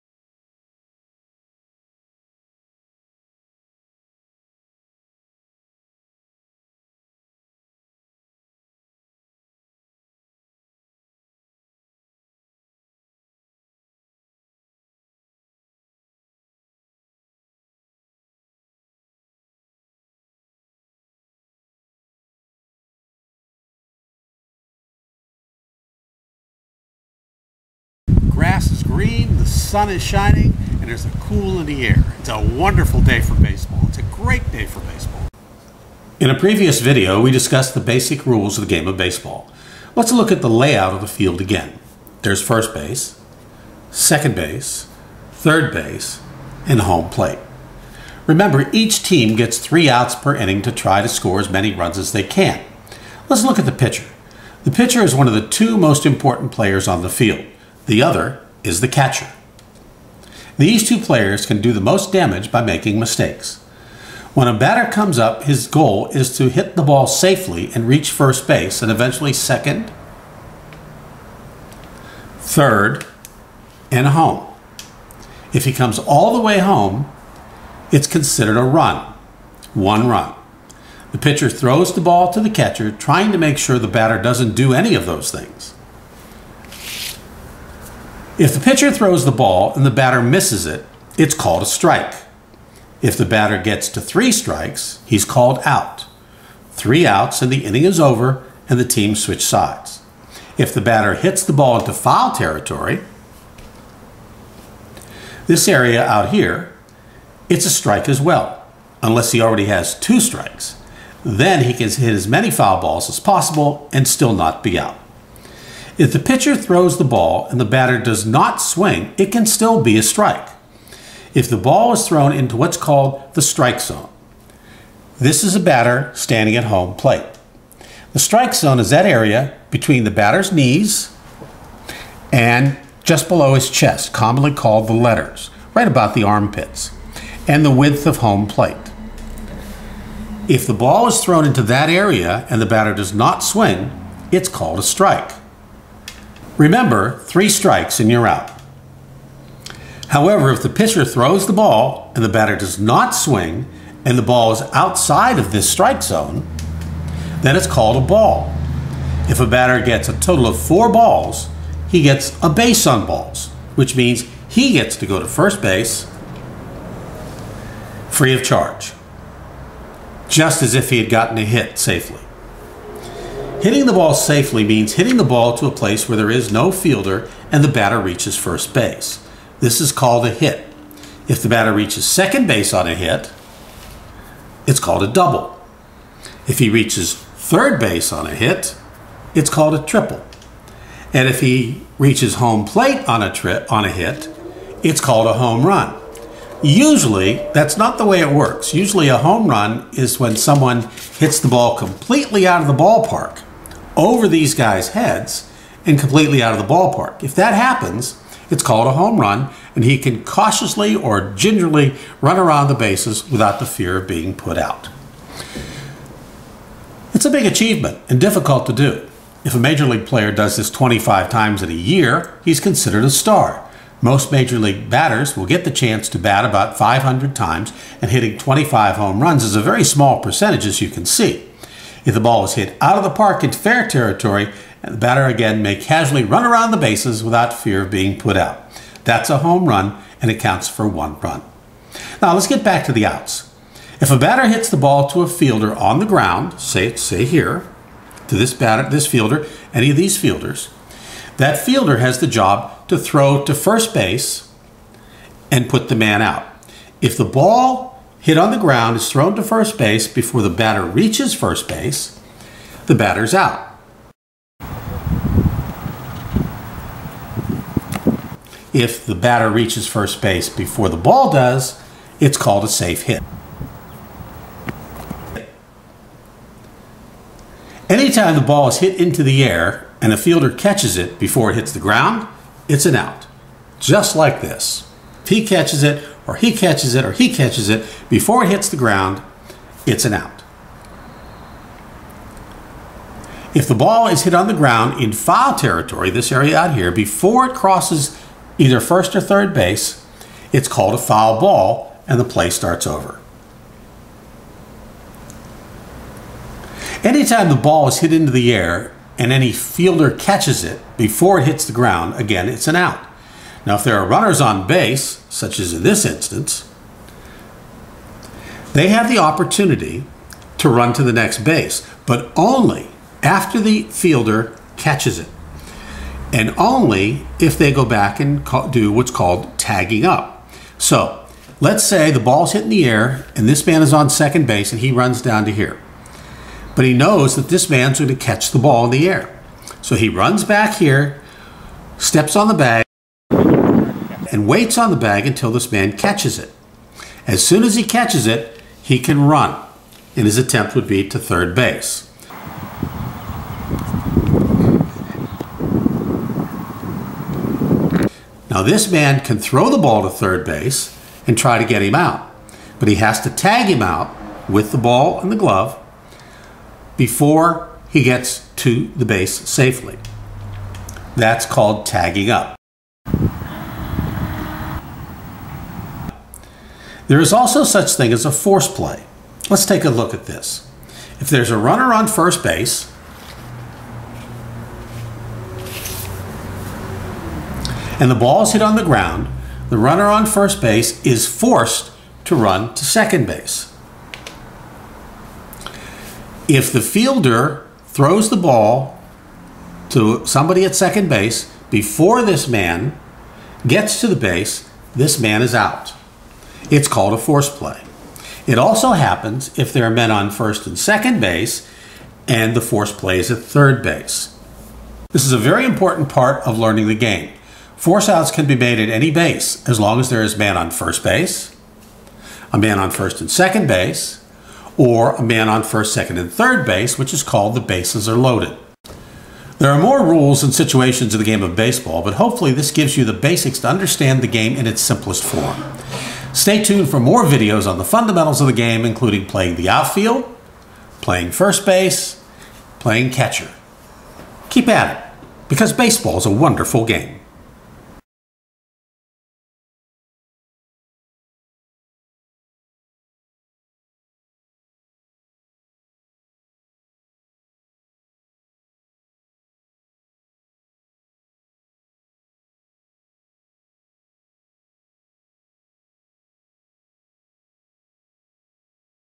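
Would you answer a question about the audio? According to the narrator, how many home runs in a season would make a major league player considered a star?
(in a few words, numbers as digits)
25.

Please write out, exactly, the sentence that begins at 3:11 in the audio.
And if he reaches home plate on a trip on a hit, it's called a home run.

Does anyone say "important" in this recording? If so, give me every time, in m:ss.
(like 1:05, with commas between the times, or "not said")
0:56, 6:55.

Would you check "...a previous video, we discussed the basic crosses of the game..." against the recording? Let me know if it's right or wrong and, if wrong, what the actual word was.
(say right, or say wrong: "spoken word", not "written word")
wrong: "rules", not "crosses".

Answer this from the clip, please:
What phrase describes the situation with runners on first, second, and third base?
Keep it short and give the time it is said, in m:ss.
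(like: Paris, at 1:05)
Bases are loaded, at 7:07.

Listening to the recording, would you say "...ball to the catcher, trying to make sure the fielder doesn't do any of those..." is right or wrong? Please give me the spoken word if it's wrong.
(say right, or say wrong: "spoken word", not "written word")
wrong: "batter", not "fielder".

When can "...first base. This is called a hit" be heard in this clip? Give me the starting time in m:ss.
2:58.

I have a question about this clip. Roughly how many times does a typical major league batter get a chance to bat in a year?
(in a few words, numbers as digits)
500.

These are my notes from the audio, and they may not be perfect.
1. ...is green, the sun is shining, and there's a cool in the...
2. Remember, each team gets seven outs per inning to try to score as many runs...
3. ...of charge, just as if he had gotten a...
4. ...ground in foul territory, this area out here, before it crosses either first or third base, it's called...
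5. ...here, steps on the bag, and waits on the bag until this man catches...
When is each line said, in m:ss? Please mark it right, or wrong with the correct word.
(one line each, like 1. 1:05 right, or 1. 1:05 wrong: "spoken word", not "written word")
1. 0:28 right
2. 0:48 wrong: "three", not "seven"
3. 2:48 right
4. 4:54 right
5. 5:40 right.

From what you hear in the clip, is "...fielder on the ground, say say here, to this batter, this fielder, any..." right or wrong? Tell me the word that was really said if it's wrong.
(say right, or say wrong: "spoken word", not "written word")
right.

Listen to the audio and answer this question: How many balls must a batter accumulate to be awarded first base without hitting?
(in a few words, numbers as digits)
4.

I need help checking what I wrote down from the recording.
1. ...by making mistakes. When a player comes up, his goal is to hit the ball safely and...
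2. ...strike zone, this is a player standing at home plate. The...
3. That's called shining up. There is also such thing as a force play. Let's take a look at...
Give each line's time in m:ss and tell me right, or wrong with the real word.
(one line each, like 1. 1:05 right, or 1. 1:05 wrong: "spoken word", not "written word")
1. 1:02 wrong: "batter", not "player"
2. 2:03 wrong: "batter", not "player"
3. 6:11 wrong: "tagging", not "shining".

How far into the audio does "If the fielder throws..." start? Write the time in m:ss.
6:36.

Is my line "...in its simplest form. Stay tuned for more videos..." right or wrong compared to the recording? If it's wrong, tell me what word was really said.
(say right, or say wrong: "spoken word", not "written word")
right.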